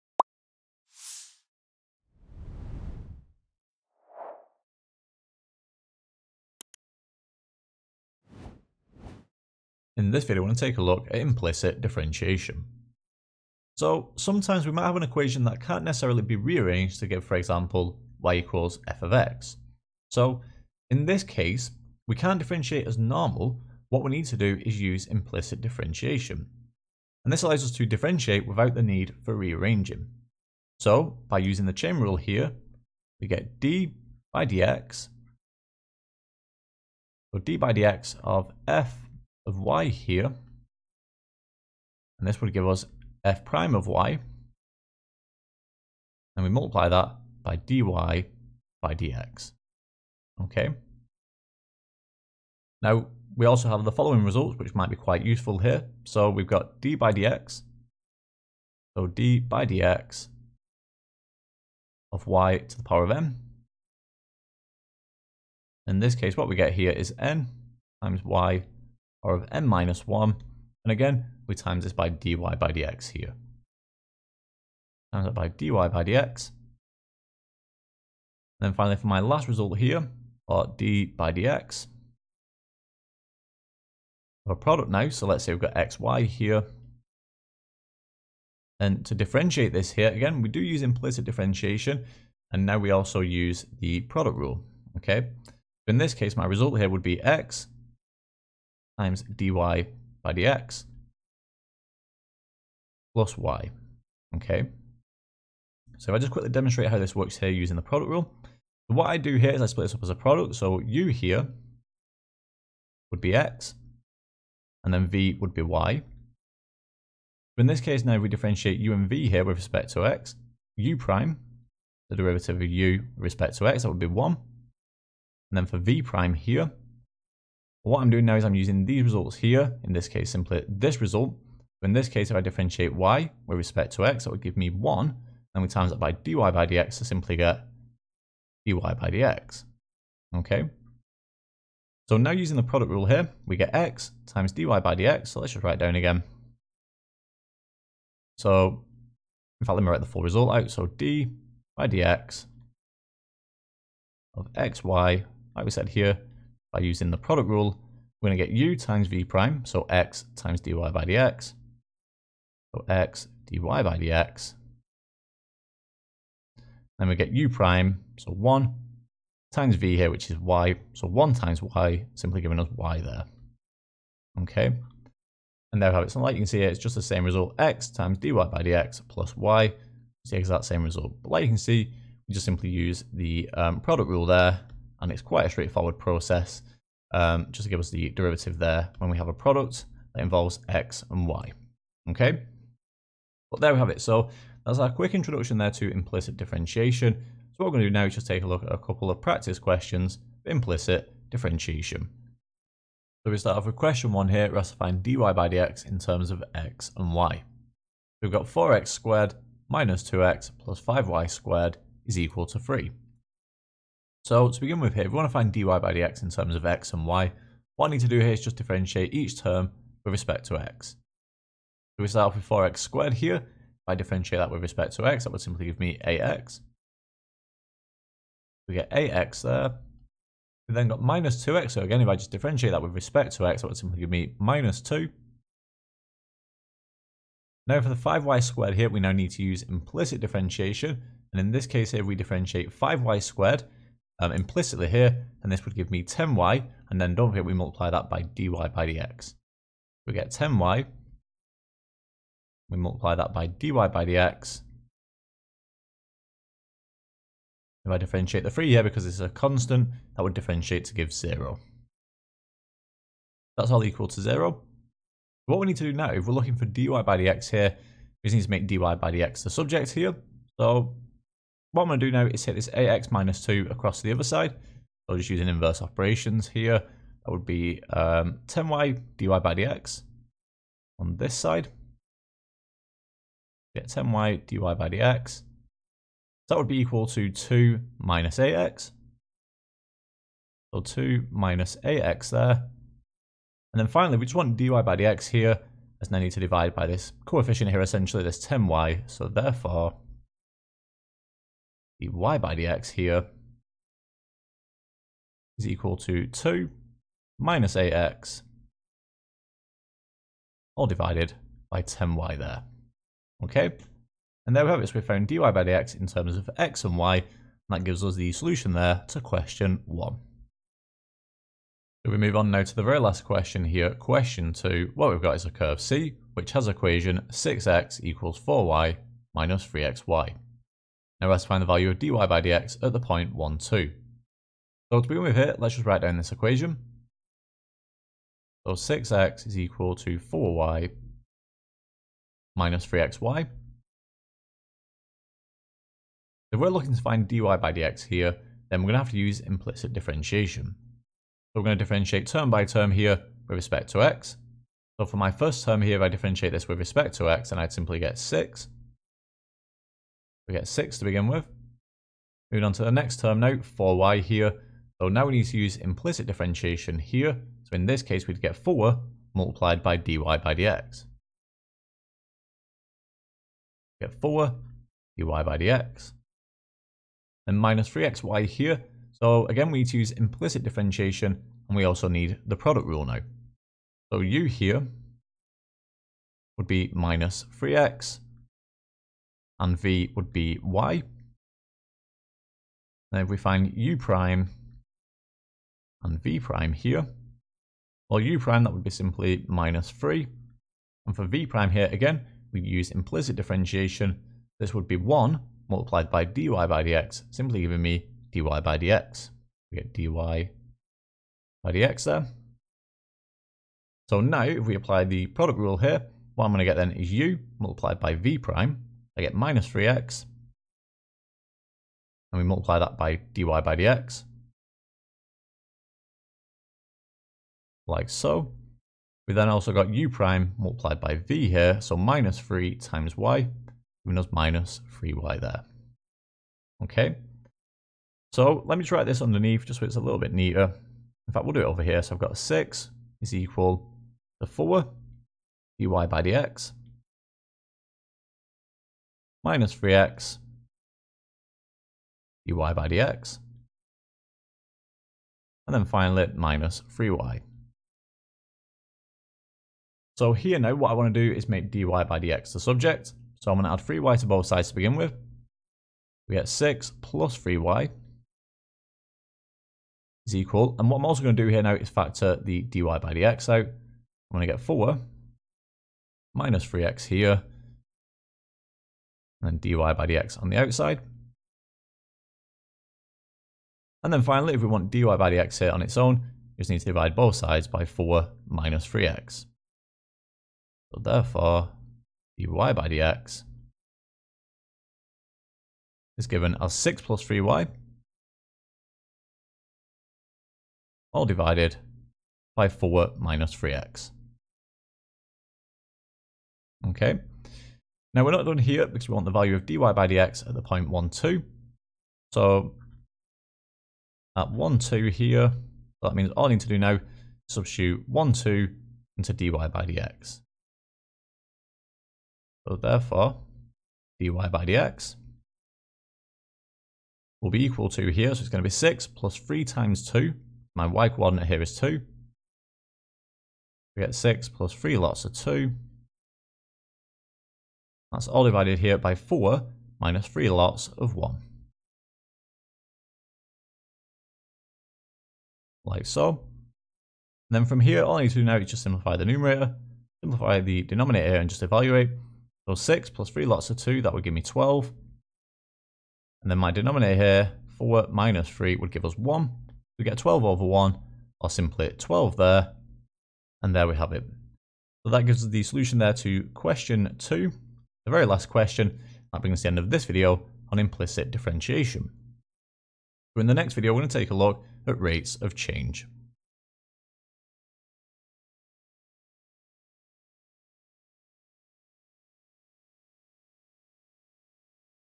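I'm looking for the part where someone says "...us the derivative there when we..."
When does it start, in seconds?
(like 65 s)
187 s.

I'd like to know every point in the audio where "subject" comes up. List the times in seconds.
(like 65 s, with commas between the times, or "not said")
269 s, 462 s.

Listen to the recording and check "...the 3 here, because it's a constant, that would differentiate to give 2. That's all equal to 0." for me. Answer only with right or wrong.
wrong.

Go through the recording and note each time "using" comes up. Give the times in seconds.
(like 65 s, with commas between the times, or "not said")
31 s, 107 s, 128 s, 142 s, 156 s.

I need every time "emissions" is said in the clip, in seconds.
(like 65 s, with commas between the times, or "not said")
not said.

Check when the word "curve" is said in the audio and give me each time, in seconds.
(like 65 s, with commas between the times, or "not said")
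325 s.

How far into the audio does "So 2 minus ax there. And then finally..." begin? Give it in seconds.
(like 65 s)
290 s.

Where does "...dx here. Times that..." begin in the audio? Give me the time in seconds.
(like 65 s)
72 s.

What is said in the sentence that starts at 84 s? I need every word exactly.
Our product now, so let's say we've got xy here.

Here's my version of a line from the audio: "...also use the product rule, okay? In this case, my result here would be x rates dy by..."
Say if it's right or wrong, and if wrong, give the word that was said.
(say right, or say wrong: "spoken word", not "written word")
wrong: "times", not "rates".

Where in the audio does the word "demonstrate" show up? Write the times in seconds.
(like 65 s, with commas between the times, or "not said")
106 s.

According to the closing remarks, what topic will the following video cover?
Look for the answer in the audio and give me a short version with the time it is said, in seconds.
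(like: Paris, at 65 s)
Rates of change, at 574 s.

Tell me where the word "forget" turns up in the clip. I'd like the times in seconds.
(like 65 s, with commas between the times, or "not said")
247 s.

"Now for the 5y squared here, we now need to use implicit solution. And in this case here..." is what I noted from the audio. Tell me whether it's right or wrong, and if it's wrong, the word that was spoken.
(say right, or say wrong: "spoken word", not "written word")
wrong: "differentiation", not "solution".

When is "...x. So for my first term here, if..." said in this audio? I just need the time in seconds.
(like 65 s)
354 s.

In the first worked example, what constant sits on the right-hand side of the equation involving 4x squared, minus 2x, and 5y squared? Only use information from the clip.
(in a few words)
3.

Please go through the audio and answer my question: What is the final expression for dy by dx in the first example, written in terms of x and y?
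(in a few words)
(2 - 8x)/(10y).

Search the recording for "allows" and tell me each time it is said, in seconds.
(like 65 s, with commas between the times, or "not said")
27 s.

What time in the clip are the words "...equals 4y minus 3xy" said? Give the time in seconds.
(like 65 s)
328 s.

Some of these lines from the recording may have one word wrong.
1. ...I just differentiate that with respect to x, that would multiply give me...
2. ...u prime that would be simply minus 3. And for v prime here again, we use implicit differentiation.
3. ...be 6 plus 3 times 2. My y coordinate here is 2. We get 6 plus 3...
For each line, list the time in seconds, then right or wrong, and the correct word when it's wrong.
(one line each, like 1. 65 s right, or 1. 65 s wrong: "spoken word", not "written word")
1. 232 s wrong: "simply", not "multiply"
2. 398 s right
3. 528 s right.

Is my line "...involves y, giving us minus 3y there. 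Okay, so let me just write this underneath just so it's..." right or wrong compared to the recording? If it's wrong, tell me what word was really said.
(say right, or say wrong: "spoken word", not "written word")
wrong: "times", not "involves".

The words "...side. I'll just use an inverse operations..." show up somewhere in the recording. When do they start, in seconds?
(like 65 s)
274 s.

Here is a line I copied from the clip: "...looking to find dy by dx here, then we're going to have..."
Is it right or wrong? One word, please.
right.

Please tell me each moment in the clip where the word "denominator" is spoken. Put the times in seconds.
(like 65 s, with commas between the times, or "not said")
550 s, 556 s.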